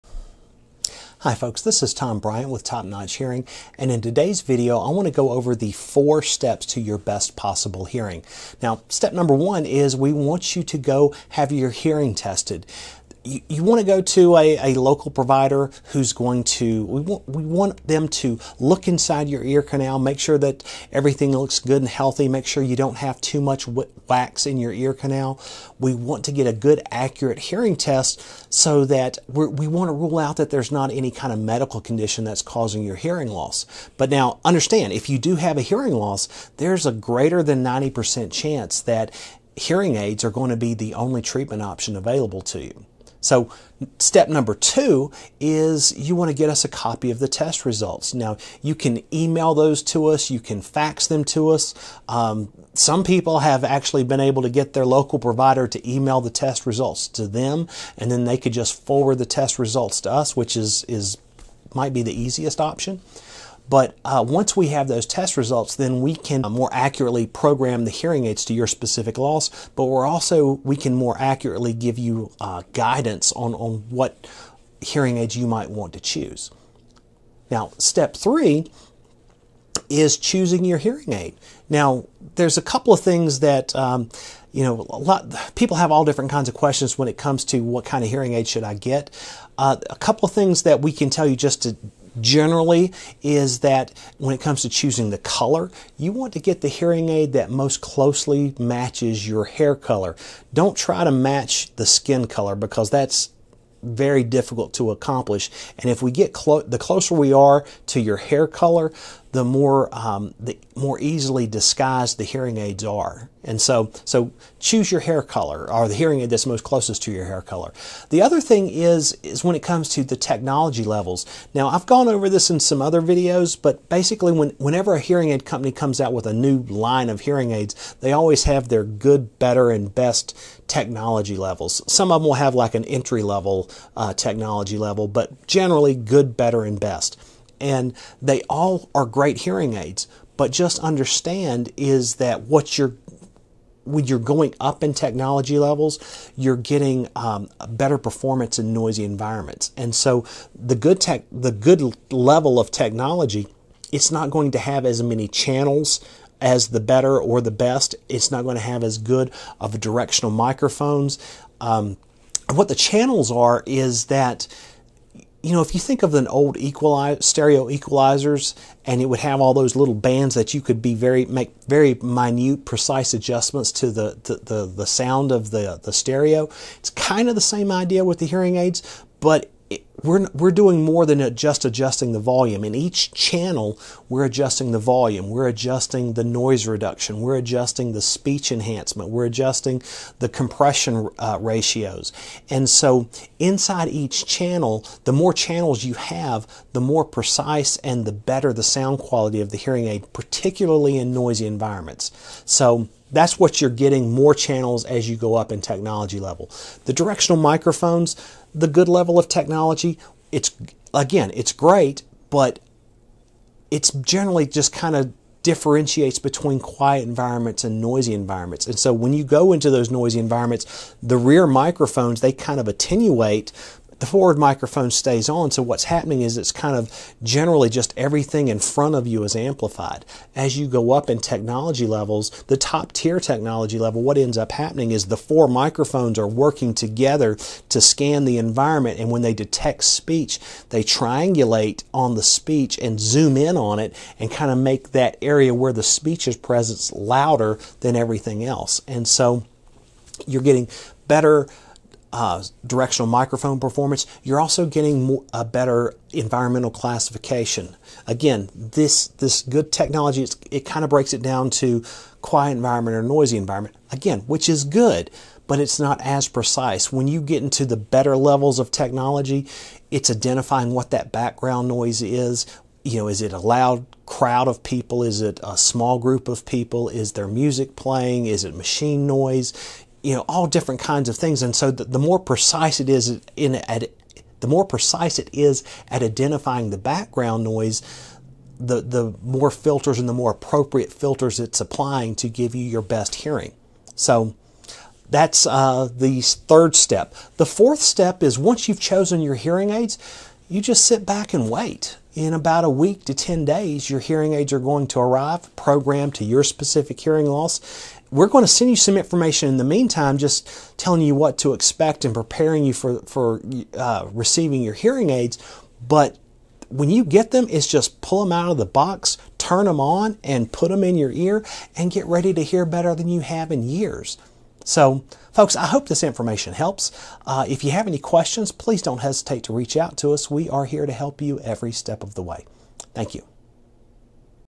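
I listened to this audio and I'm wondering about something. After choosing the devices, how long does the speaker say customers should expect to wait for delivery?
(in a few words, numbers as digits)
a week to 10 days.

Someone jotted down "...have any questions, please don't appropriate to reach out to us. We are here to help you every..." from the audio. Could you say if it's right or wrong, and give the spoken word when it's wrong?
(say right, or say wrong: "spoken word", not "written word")
wrong: "hesitate", not "appropriate".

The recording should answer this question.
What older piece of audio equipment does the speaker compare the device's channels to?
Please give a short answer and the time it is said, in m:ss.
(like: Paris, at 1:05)
stereo equalizers, at 2:46.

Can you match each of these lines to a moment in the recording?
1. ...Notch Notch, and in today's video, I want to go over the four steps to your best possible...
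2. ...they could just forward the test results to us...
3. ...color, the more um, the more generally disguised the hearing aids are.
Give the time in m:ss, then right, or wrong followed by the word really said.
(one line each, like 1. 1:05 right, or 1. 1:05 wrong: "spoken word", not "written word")
1. 0:02 wrong: "Hearing", not "Notch"
2. 0:58 right
3. 1:48 wrong: "easily", not "generally".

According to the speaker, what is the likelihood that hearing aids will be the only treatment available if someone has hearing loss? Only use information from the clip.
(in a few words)
greater than 90%.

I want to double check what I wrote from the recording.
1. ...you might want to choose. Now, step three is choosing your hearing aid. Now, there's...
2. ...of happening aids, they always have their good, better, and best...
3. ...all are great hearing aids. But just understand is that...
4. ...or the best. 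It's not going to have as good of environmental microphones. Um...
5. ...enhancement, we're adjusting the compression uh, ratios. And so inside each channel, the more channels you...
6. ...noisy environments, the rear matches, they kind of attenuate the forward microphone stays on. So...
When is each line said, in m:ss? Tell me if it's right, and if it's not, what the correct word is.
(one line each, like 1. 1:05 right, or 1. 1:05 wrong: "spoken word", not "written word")
1. 1:15 right
2. 2:07 wrong: "hearing", not "happening"
3. 2:18 right
4. 2:37 wrong: "directional", not "environmental"
5. 3:08 right
6. 3:39 wrong: "microphones", not "matches".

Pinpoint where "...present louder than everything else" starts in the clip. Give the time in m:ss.
4:06.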